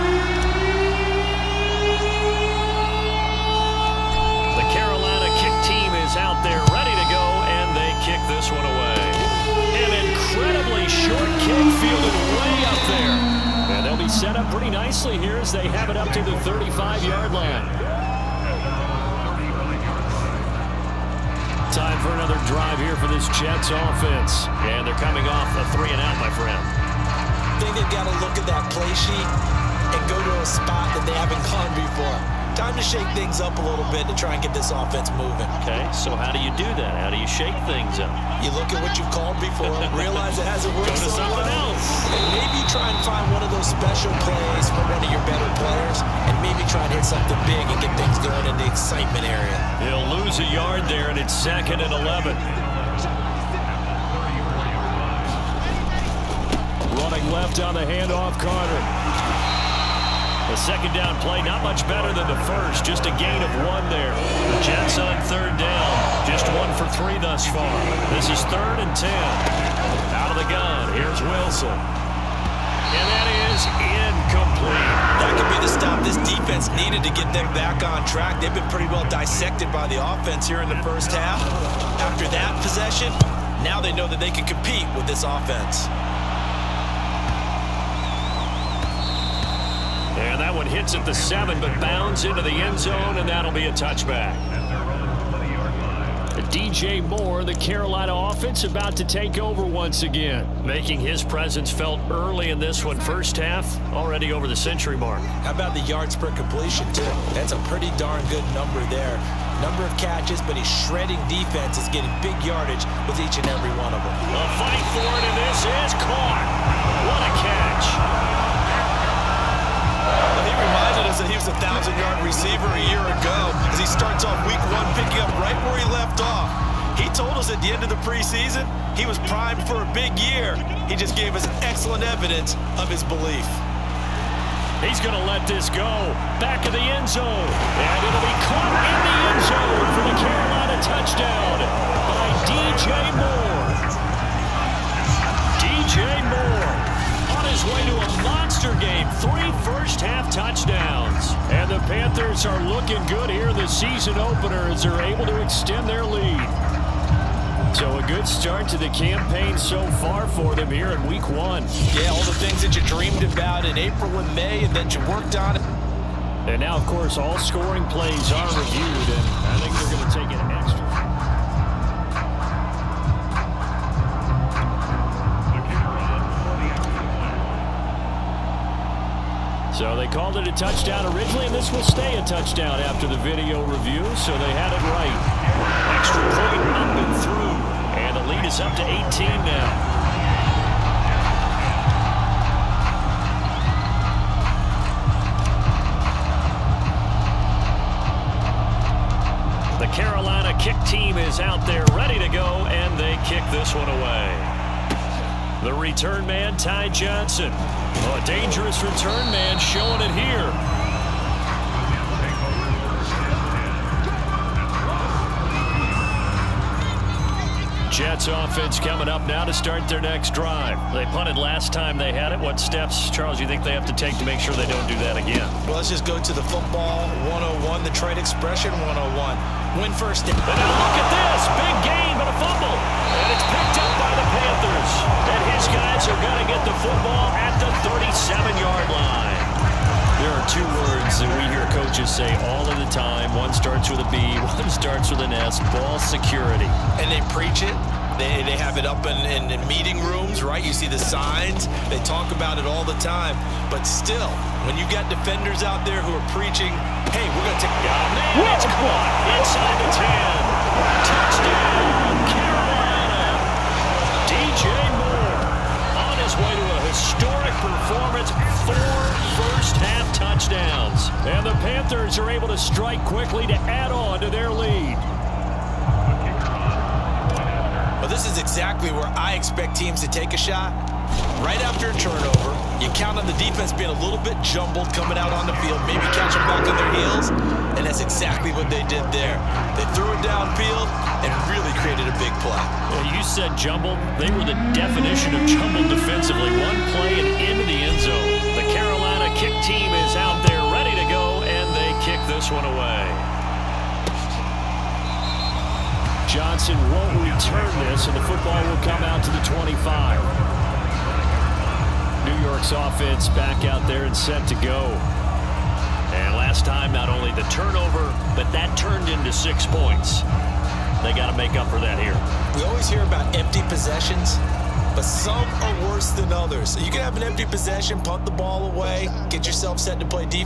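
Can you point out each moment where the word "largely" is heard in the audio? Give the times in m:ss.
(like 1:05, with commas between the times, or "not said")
not said.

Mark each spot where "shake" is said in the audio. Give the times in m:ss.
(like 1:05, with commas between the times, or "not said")
0:32, 0:37.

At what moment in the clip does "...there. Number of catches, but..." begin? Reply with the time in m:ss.
1:48.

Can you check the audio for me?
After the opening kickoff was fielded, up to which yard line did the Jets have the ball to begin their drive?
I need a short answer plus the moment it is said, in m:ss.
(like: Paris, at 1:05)
35, at 0:16.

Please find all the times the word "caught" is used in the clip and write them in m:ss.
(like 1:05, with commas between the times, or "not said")
1:56, 2:18, 4:18.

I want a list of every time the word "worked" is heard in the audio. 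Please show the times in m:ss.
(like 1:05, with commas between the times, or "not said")
0:40, 2:45.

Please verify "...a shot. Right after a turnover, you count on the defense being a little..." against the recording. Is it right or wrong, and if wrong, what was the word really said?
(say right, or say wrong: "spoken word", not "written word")
right.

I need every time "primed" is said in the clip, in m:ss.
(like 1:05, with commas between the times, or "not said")
2:09.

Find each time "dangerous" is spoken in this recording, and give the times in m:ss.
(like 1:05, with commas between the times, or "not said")
3:28.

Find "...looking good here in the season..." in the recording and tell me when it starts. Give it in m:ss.
2:32.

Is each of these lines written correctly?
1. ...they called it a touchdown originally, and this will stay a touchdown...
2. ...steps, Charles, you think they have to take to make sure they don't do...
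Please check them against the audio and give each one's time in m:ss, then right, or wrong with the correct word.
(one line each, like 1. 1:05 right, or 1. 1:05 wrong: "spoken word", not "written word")
1. 2:59 right
2. 3:42 right.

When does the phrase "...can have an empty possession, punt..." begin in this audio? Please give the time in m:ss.
5:26.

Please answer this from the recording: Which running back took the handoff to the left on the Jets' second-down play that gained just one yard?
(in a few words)
Carter.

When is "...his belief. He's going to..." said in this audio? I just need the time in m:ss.
2:12.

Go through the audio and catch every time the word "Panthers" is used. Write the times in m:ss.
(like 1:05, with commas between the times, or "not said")
2:31, 4:31.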